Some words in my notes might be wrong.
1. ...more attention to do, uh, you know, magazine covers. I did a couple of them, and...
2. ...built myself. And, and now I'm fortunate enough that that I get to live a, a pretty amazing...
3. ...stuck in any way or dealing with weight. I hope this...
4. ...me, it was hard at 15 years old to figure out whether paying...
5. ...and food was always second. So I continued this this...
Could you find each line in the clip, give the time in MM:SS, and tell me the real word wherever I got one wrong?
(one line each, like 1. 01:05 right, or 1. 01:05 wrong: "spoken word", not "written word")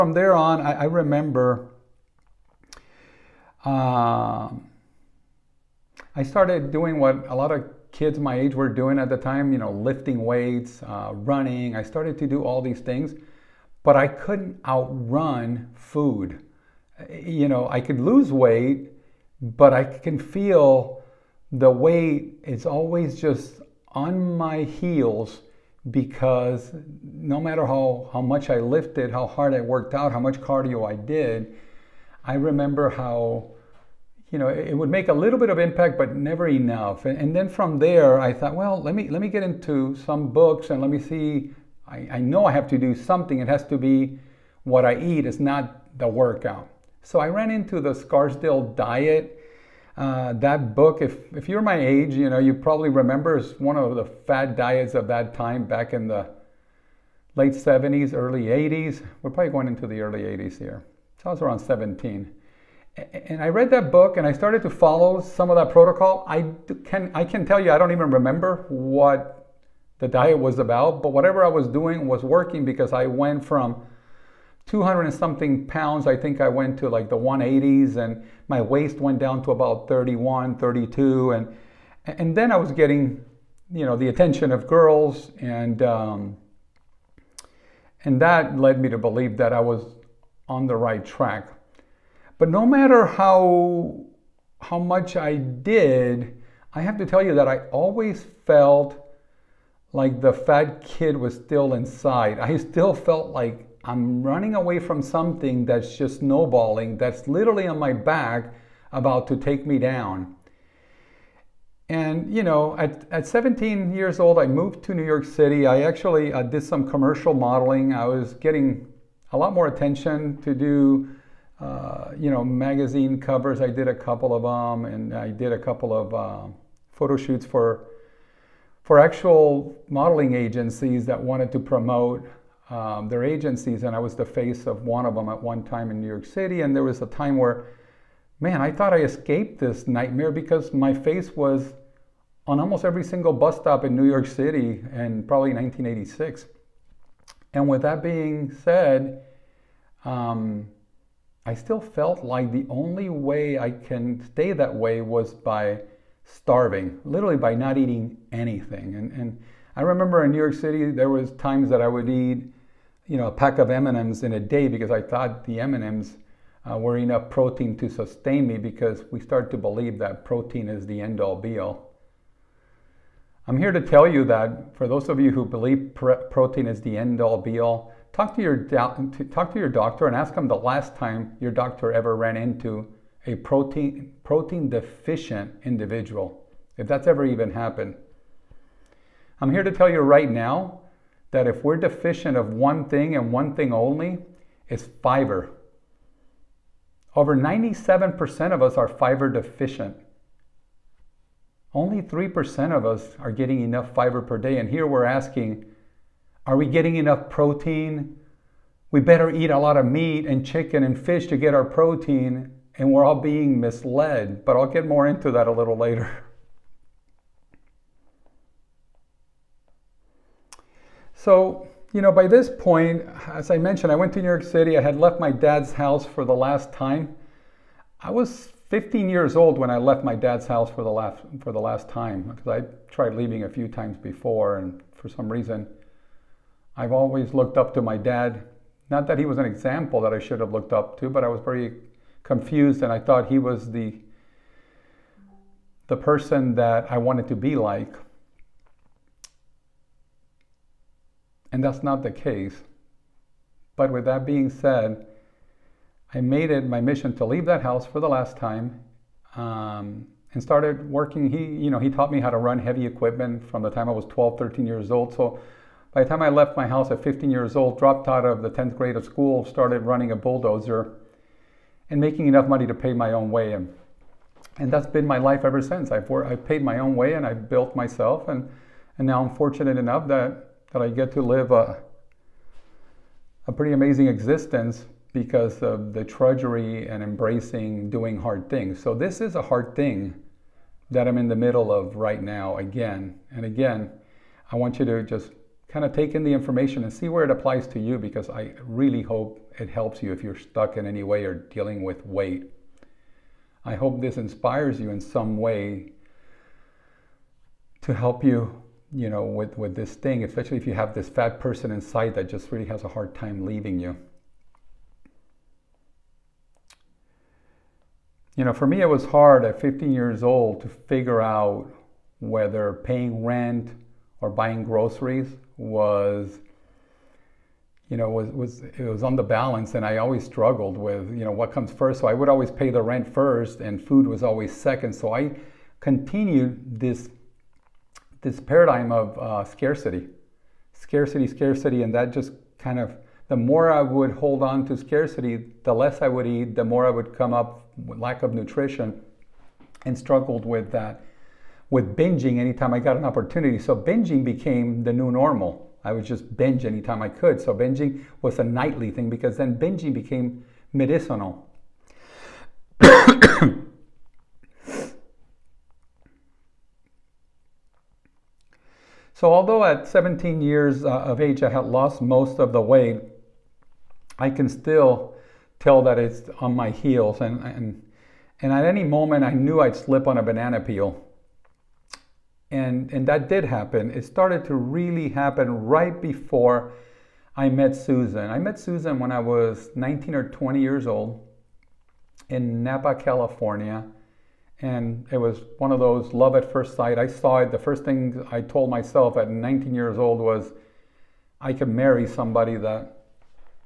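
1. 01:59 right
2. 04:37 right
3. 05:00 right
4. 05:18 right
5. 05:33 right.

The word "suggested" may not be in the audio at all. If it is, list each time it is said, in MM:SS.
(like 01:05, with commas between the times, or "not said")
not said.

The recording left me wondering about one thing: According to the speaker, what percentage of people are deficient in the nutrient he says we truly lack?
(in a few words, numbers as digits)
97%.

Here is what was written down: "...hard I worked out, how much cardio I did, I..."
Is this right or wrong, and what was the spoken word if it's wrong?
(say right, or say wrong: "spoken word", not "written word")
right.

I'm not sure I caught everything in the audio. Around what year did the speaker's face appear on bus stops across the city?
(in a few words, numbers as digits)
1986.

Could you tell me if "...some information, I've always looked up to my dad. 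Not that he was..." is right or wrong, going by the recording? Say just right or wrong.
wrong.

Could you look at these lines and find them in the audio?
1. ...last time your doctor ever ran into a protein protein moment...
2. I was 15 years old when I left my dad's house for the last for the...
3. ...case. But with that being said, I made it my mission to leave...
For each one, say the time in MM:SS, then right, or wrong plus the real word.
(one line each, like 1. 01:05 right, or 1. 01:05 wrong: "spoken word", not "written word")
1. 03:00 wrong: "deficient", not "moment"
2. 03:48 right
3. 04:12 right.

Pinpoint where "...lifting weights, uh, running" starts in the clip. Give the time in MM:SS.
00:09.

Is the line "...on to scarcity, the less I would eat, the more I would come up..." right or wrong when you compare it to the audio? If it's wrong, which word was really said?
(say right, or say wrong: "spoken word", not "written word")
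right.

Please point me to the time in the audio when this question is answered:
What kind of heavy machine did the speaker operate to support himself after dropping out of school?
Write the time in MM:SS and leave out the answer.
04:30.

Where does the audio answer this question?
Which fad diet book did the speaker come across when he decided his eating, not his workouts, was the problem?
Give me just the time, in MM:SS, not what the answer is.
00:47.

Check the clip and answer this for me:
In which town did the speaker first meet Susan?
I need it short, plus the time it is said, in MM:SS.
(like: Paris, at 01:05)
Napa, California, at 06:32.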